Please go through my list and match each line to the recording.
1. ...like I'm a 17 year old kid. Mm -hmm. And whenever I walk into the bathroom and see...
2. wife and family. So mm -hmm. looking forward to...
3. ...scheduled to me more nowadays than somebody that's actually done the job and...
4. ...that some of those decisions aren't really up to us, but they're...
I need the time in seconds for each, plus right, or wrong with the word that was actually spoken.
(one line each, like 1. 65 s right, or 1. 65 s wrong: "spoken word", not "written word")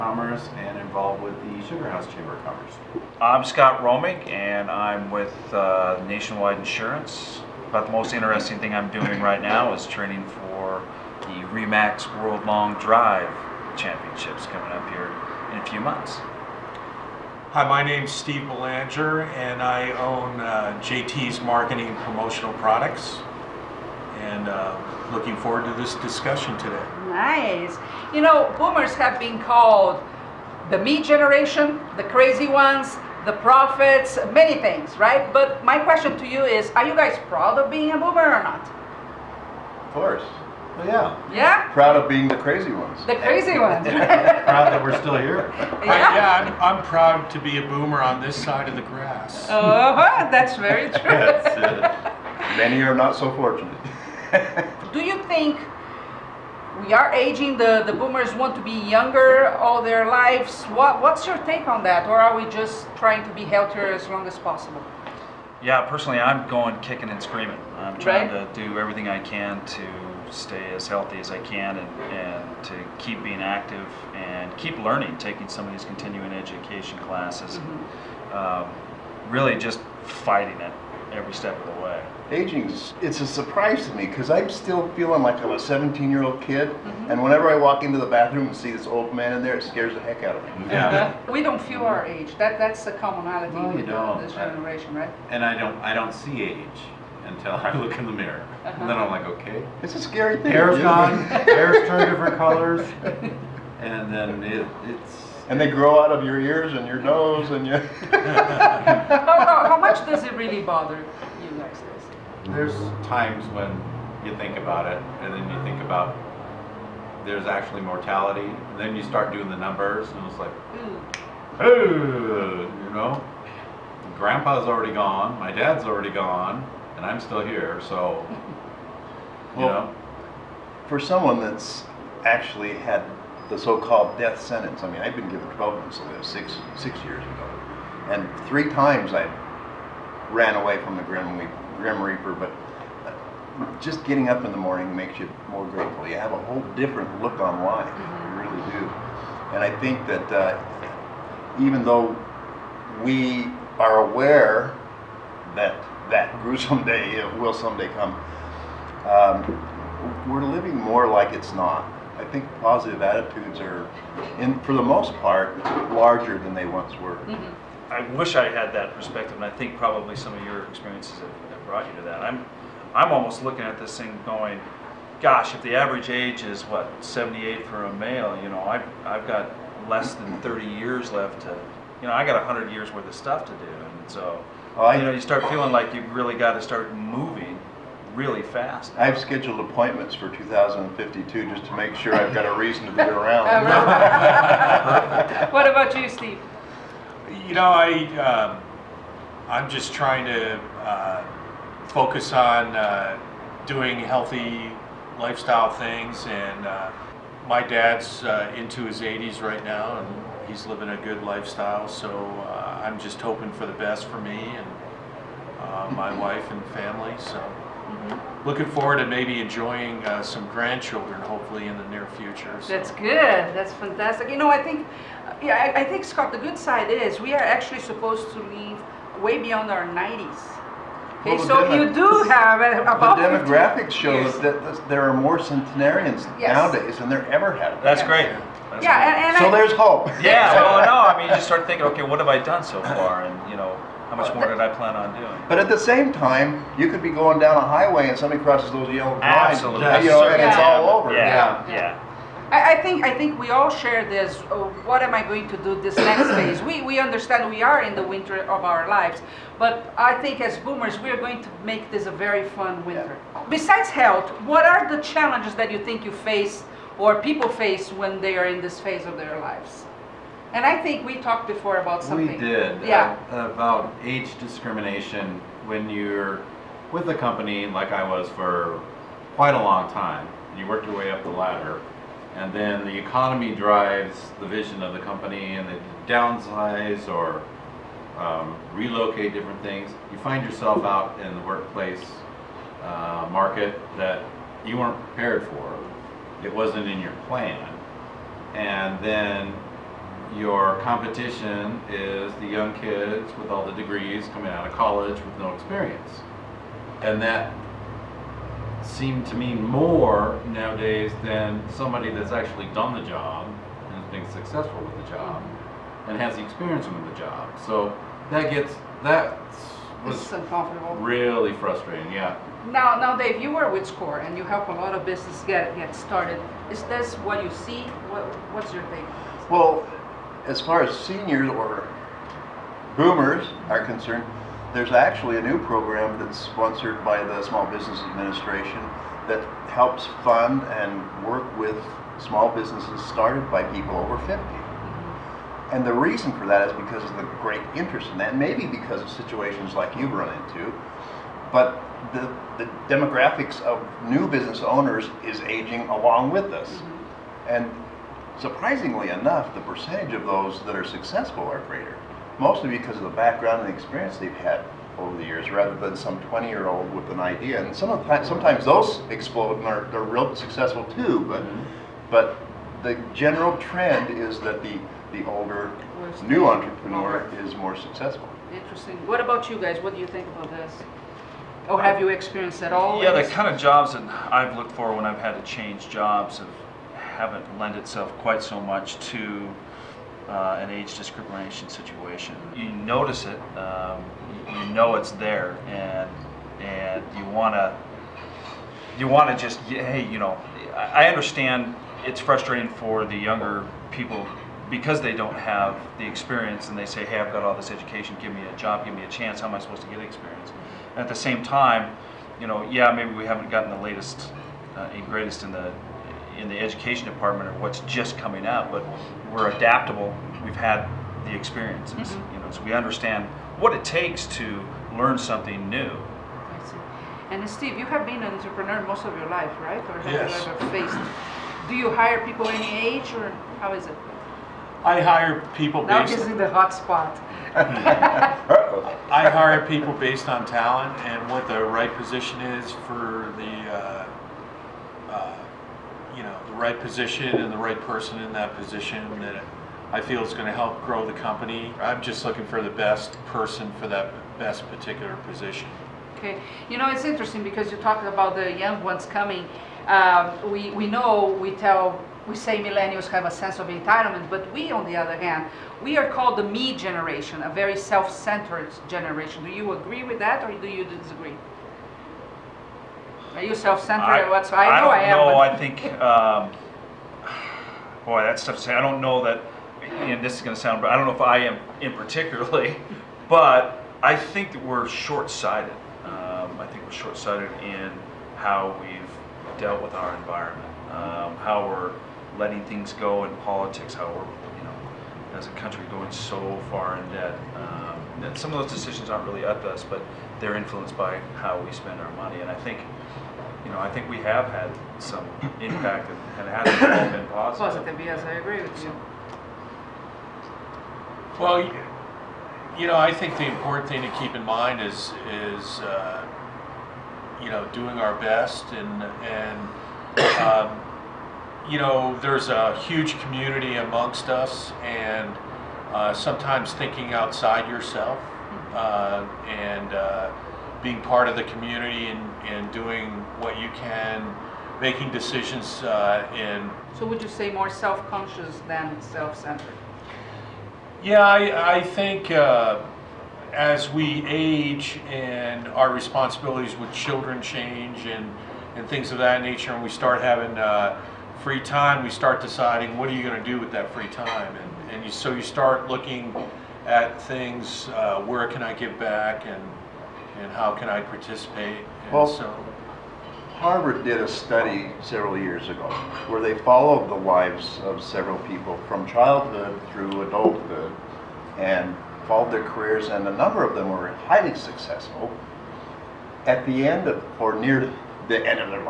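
1. 85 s right
2. 216 s right
3. 308 s wrong: "seemed", not "scheduled"
4. 498 s right.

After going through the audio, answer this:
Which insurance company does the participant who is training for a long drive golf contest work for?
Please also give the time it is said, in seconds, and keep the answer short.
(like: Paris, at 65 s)
Nationwide Insurance, at 6 s.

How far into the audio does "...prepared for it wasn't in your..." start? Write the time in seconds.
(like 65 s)
295 s.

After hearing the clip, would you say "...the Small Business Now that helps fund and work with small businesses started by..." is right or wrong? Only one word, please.
wrong.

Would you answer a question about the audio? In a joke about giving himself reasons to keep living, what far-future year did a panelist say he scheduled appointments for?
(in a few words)
2052.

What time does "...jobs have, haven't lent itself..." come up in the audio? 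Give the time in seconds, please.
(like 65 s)
385 s.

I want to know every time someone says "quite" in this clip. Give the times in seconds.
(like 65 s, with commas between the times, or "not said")
279 s, 388 s.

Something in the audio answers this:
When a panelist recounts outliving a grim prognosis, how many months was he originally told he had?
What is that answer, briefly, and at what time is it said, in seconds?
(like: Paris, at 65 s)
12, at 135 s.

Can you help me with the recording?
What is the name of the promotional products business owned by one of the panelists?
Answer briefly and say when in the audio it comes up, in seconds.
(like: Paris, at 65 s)
JT's Marketing Promotional Products, at 20 s.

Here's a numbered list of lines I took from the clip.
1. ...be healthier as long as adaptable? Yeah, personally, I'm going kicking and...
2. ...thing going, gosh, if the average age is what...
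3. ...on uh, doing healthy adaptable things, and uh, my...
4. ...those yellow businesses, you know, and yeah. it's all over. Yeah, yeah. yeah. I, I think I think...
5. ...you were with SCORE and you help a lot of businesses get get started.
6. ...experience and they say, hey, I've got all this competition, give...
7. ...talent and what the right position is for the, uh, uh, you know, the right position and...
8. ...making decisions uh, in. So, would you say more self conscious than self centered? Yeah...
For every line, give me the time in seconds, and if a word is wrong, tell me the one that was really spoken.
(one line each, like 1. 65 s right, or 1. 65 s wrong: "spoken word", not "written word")
1. 63 s wrong: "possible", not "adaptable"
2. 173 s right
3. 202 s wrong: "lifestyle", not "adaptable"
4. 248 s wrong: "lines", not "businesses"
5. 323 s right
6. 406 s wrong: "education", not "competition"
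7. 440 s right
8. 534 s right.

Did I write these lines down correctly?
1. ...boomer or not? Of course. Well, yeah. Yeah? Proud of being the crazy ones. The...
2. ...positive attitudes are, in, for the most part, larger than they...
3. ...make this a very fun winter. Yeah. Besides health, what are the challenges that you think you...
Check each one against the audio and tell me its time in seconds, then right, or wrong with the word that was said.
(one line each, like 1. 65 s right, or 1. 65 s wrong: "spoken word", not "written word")
1. 37 s right
2. 162 s right
3. 261 s right.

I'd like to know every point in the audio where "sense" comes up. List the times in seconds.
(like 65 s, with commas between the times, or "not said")
463 s.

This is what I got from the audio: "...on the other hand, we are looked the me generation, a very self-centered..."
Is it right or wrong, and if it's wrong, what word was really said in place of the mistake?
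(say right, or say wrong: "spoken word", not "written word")
wrong: "called", not "looked".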